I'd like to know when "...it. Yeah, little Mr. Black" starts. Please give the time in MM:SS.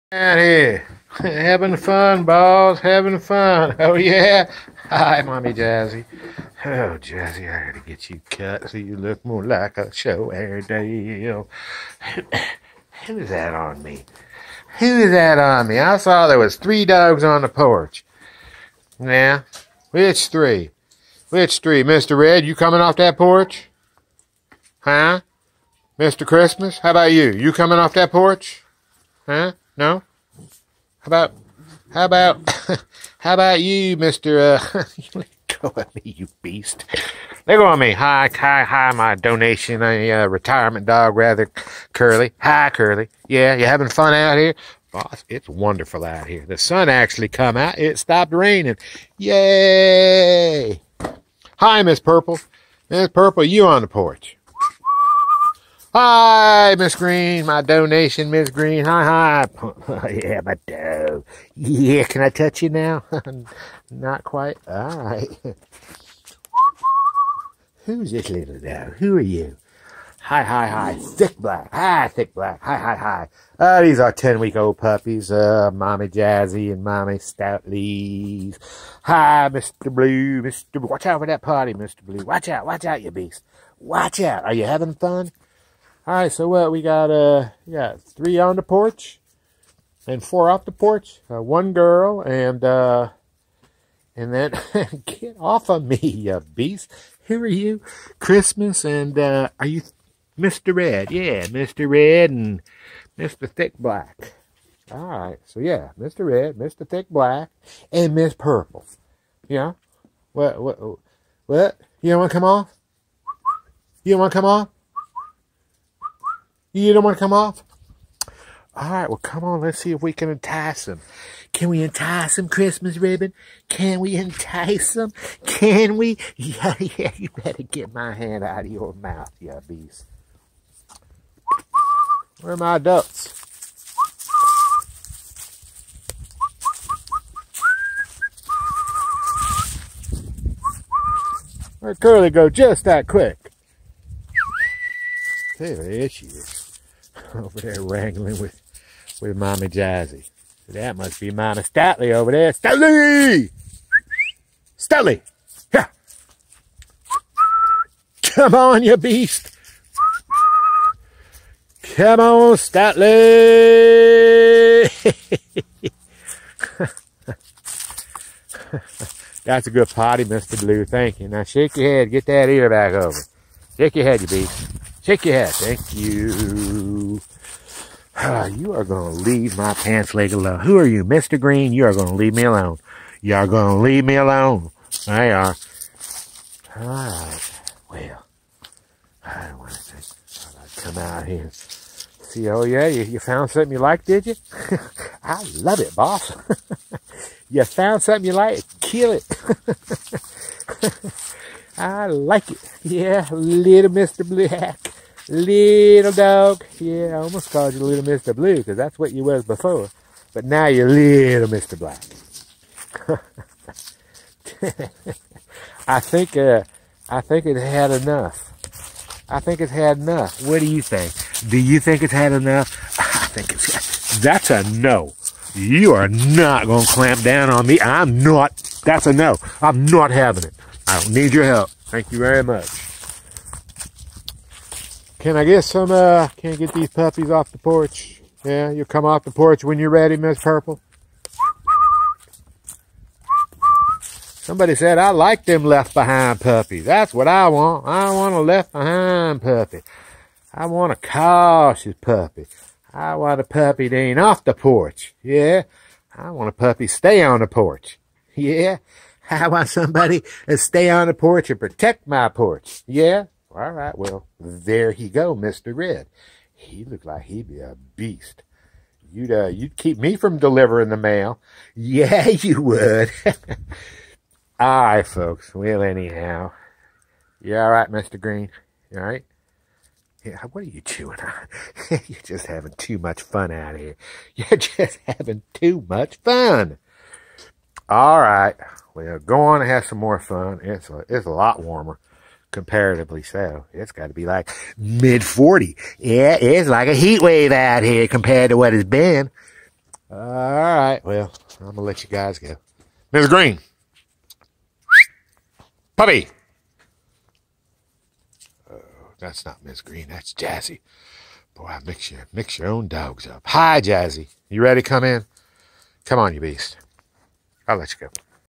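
03:22.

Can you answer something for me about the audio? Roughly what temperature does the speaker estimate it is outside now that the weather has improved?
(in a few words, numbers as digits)
mid 40s.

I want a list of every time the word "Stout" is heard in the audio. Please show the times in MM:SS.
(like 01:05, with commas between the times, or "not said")
01:17.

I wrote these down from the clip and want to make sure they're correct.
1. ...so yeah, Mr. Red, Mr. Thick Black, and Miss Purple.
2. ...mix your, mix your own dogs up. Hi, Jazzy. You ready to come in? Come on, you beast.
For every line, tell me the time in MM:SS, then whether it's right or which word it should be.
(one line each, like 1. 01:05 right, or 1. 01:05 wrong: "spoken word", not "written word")
1. 01:45 right
2. 05:11 right.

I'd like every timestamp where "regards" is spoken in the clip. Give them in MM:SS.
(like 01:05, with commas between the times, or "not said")
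not said.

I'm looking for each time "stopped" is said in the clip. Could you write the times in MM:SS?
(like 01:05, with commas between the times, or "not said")
00:47.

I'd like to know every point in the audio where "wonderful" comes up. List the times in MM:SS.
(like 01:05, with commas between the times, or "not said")
00:45.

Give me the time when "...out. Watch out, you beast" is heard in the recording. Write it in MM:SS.
01:22.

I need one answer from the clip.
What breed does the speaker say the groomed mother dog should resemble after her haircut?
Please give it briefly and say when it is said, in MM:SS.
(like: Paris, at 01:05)
Airedale, at 00:10.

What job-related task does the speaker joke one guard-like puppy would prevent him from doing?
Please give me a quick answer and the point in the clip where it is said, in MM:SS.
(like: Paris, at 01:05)
delivering the mail, at 04:30.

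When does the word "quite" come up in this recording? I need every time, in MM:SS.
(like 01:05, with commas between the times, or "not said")
01:04.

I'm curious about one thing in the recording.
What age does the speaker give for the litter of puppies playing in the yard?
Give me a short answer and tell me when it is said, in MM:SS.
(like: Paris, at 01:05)
10 weeks, at 01:14.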